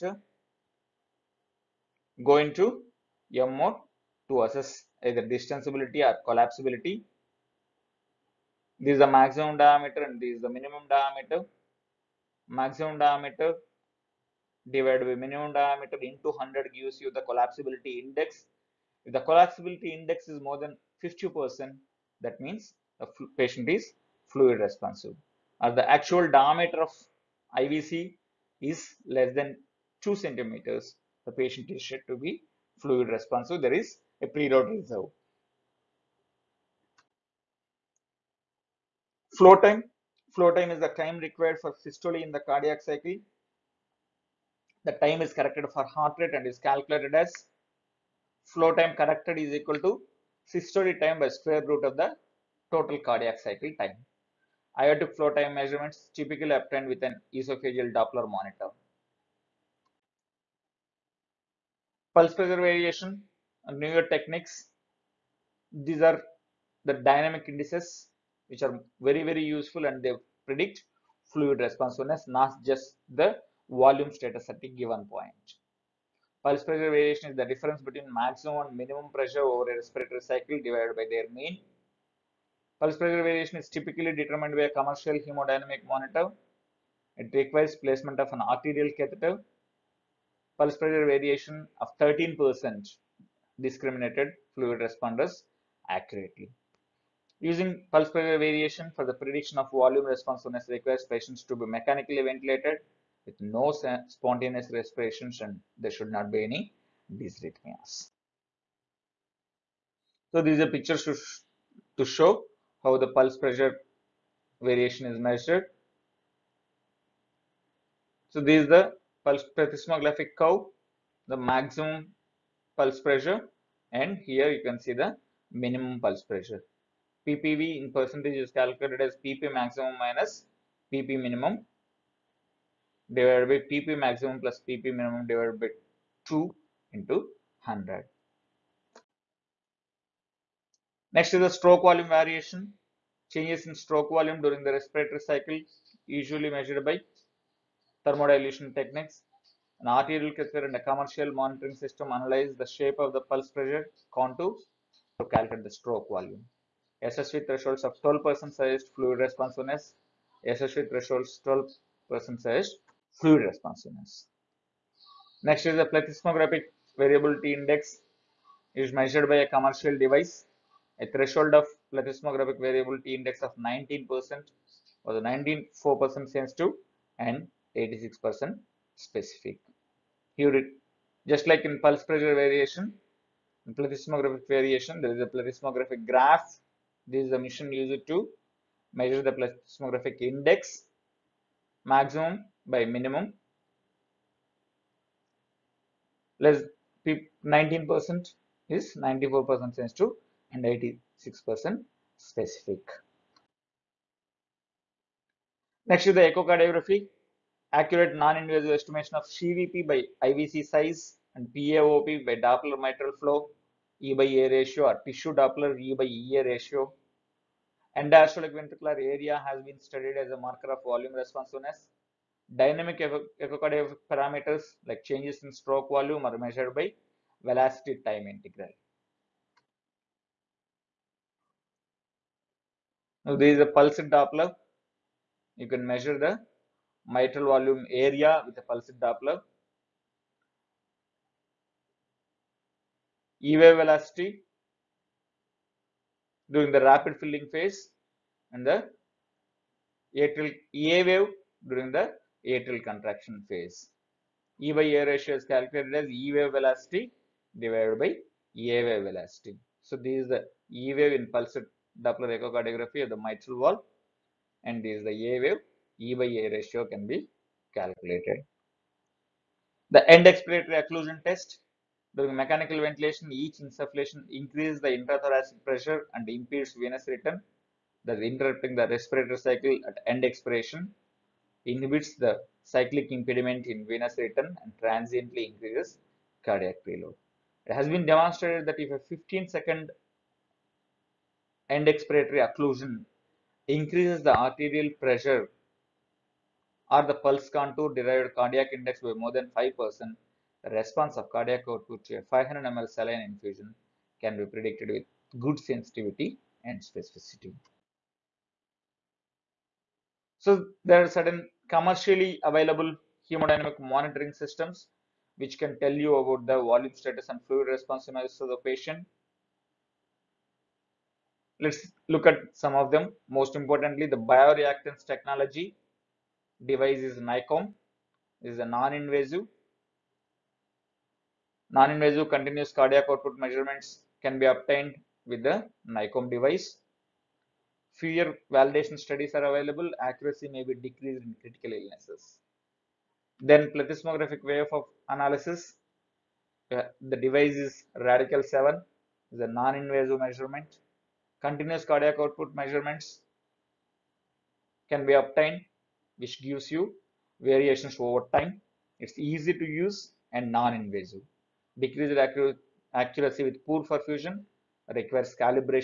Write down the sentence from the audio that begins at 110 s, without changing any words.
So these are pictures to show how the pulse pressure variation is measured.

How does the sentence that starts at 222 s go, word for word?
Dynamic echocardiographic parameters like changes in stroke volume are measured by velocity time integral.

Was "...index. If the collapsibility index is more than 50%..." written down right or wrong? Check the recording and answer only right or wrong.
right.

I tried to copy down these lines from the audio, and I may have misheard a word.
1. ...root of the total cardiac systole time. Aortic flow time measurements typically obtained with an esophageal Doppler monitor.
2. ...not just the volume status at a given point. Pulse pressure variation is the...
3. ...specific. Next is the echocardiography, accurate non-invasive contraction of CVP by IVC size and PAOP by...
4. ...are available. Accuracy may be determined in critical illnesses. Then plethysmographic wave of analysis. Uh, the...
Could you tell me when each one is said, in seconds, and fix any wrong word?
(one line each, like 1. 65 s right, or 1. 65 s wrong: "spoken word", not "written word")
1. 51 s wrong: "cycle", not "systole"
2. 72 s right
3. 202 s wrong: "estimation", not "contraction"
4. 339 s wrong: "decreased", not "determined".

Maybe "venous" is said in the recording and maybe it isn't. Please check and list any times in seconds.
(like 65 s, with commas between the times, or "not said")
276 s, 283 s.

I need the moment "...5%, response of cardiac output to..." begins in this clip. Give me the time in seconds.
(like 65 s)
299 s.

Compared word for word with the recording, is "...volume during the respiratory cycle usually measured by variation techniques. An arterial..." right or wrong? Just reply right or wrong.
wrong.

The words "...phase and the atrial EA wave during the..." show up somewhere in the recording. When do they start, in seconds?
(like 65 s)
247 s.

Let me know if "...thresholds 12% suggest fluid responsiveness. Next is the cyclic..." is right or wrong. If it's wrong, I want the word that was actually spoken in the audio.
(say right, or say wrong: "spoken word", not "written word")
wrong: "plethysmographic", not "cyclic".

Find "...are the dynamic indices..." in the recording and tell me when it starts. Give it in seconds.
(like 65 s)
66 s.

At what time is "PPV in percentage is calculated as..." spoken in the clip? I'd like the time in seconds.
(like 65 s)
127 s.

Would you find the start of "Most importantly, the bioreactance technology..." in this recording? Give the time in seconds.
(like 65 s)
323 s.